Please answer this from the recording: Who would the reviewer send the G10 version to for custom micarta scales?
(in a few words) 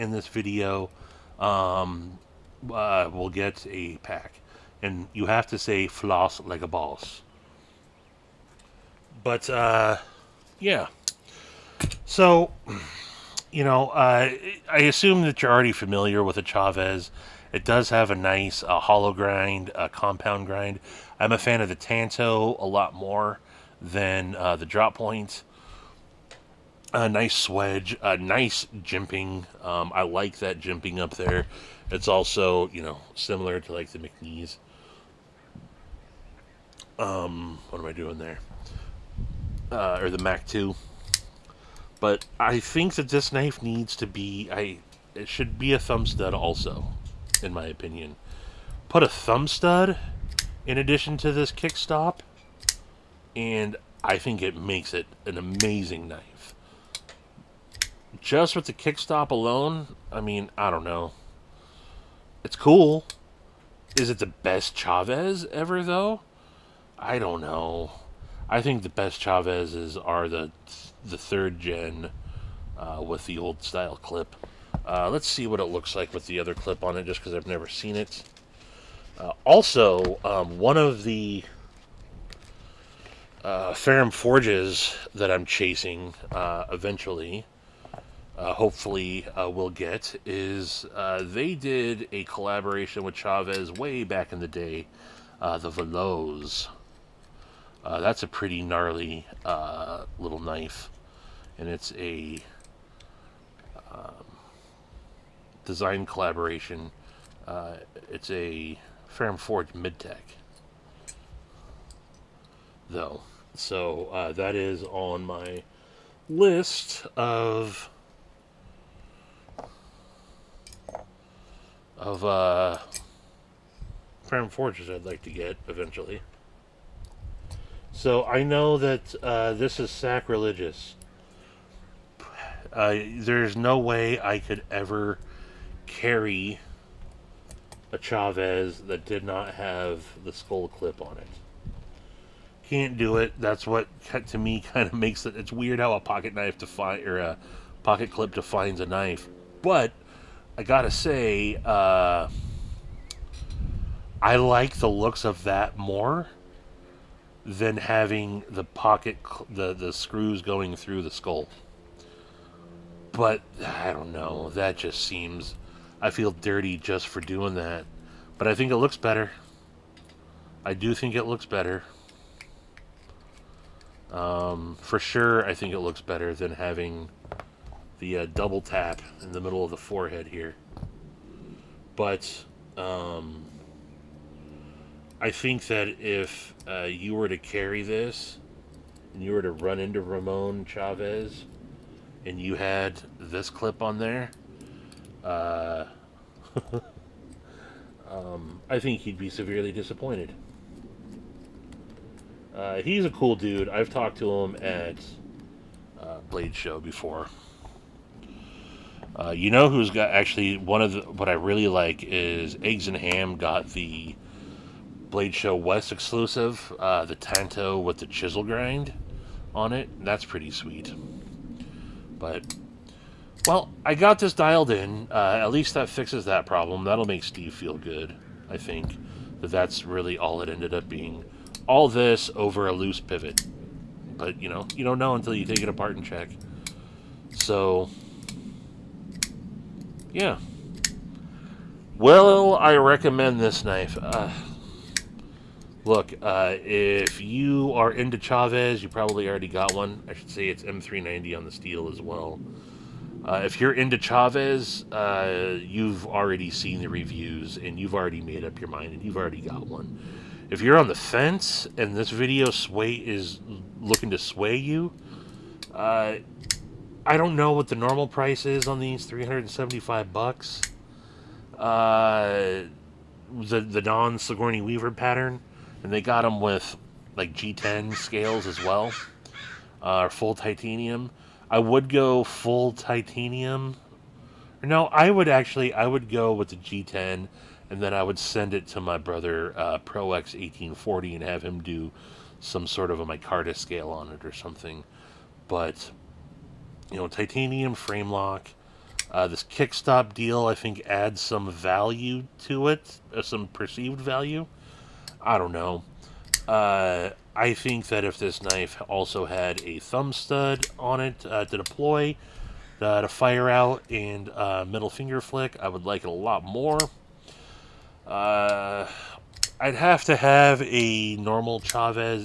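Pro X 1840.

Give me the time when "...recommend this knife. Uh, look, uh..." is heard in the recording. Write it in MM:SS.
04:02.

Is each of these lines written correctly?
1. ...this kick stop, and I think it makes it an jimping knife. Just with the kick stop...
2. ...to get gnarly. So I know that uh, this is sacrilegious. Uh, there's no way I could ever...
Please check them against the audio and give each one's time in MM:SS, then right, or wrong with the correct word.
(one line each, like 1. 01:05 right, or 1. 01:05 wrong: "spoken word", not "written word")
1. 00:51 wrong: "amazing", not "jimping"
2. 02:05 wrong: "eventually", not "gnarly".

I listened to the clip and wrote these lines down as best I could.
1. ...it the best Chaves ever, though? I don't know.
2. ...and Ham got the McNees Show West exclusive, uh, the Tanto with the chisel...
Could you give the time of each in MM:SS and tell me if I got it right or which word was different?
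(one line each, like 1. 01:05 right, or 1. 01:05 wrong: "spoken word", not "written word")
1. 01:04 right
2. 03:32 wrong: "Blade", not "McNees".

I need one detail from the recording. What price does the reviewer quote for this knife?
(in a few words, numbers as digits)
$375.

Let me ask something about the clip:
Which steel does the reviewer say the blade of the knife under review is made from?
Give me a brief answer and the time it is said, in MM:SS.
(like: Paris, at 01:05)
M390, at 04:10.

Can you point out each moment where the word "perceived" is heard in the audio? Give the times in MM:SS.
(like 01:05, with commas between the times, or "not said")
05:03.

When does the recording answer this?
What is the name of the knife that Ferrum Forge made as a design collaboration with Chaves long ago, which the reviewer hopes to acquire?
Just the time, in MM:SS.
01:35.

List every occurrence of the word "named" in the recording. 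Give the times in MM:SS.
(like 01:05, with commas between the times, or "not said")
not said.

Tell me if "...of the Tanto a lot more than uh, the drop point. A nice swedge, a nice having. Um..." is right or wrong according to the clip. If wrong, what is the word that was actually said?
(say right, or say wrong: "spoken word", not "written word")
wrong: "jimping", not "having".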